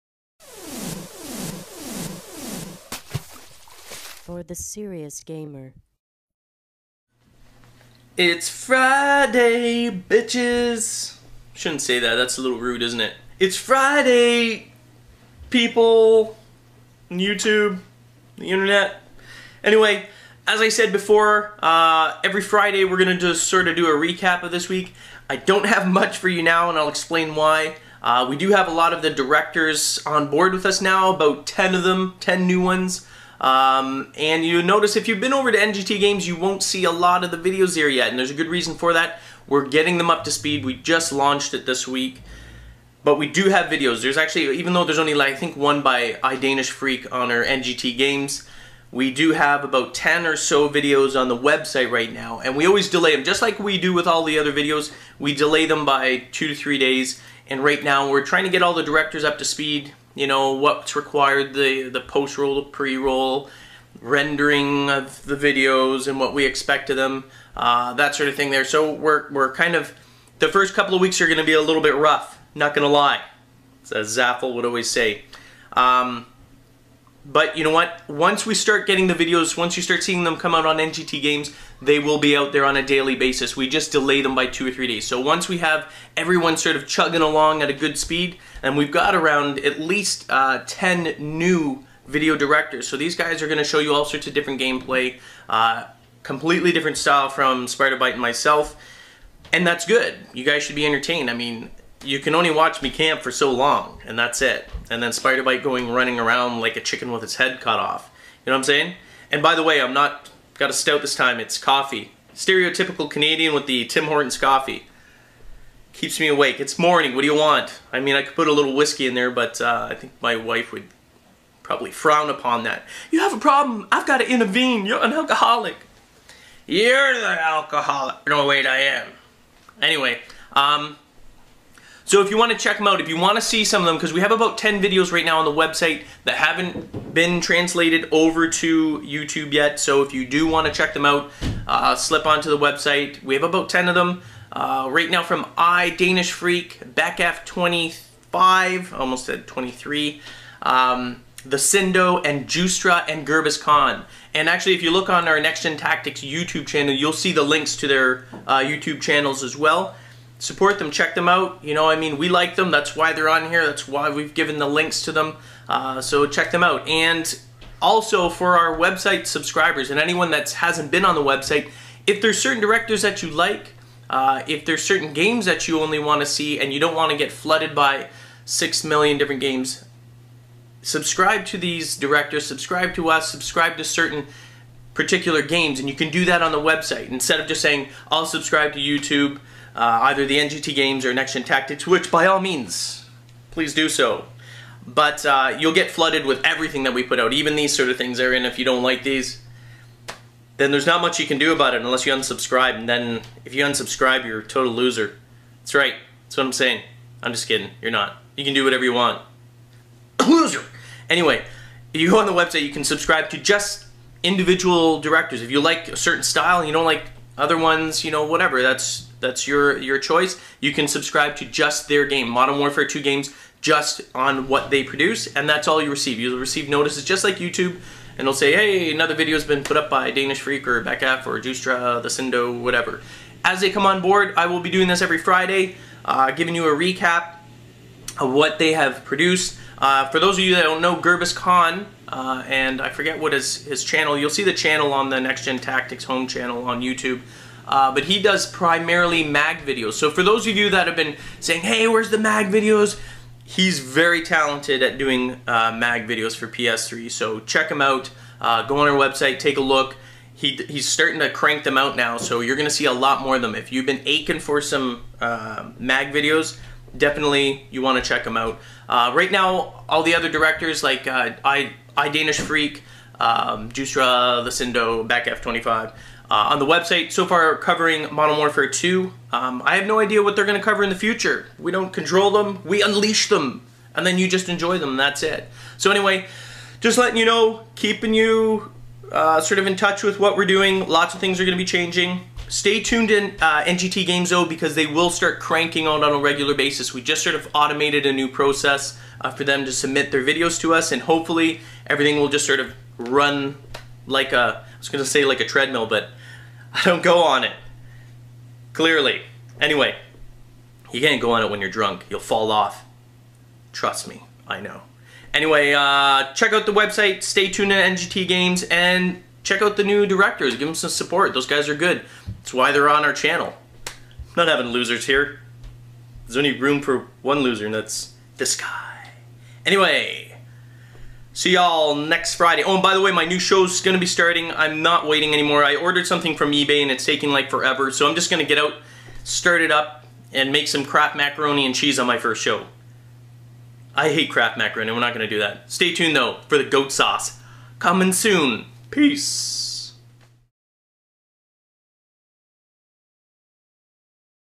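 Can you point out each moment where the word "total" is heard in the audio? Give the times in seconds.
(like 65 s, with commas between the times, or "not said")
204 s.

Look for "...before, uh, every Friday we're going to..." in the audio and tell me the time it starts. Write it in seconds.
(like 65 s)
20 s.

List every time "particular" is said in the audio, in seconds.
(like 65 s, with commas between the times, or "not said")
184 s.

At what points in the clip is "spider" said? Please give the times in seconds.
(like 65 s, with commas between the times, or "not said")
97 s, 105 s.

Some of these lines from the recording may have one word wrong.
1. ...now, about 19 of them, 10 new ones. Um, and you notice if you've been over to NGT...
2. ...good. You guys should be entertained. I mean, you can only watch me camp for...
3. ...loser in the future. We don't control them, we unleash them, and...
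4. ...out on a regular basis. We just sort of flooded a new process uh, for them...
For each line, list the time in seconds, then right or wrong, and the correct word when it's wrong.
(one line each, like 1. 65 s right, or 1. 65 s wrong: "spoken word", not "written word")
1. 30 s wrong: "10", not "19"
2. 99 s right
3. 280 s wrong: "cover", not "loser"
4. 295 s wrong: "automated", not "flooded".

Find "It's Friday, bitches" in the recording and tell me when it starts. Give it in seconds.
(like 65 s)
8 s.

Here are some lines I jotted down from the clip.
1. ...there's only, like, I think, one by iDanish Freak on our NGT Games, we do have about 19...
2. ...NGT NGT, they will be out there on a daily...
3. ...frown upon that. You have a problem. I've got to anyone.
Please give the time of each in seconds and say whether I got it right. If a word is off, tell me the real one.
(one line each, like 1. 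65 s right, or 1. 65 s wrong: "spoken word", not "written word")
1. 44 s wrong: "10", not "19"
2. 80 s wrong: "Games", not "NGT"
3. 121 s wrong: "intervene", not "anyone".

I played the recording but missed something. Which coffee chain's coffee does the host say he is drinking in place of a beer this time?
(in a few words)
Tim Hortons.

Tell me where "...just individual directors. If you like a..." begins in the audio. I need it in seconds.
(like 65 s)
213 s.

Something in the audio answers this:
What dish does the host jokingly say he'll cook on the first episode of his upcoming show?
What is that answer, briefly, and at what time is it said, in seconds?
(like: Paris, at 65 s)
macaroni and cheese, at 341 s.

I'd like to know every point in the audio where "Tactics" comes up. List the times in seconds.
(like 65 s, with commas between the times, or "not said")
155 s, 191 s, 245 s.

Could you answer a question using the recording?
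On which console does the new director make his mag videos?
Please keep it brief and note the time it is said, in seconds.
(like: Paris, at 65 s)
PS3, at 256 s.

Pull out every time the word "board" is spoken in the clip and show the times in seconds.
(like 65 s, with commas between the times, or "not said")
30 s, 234 s.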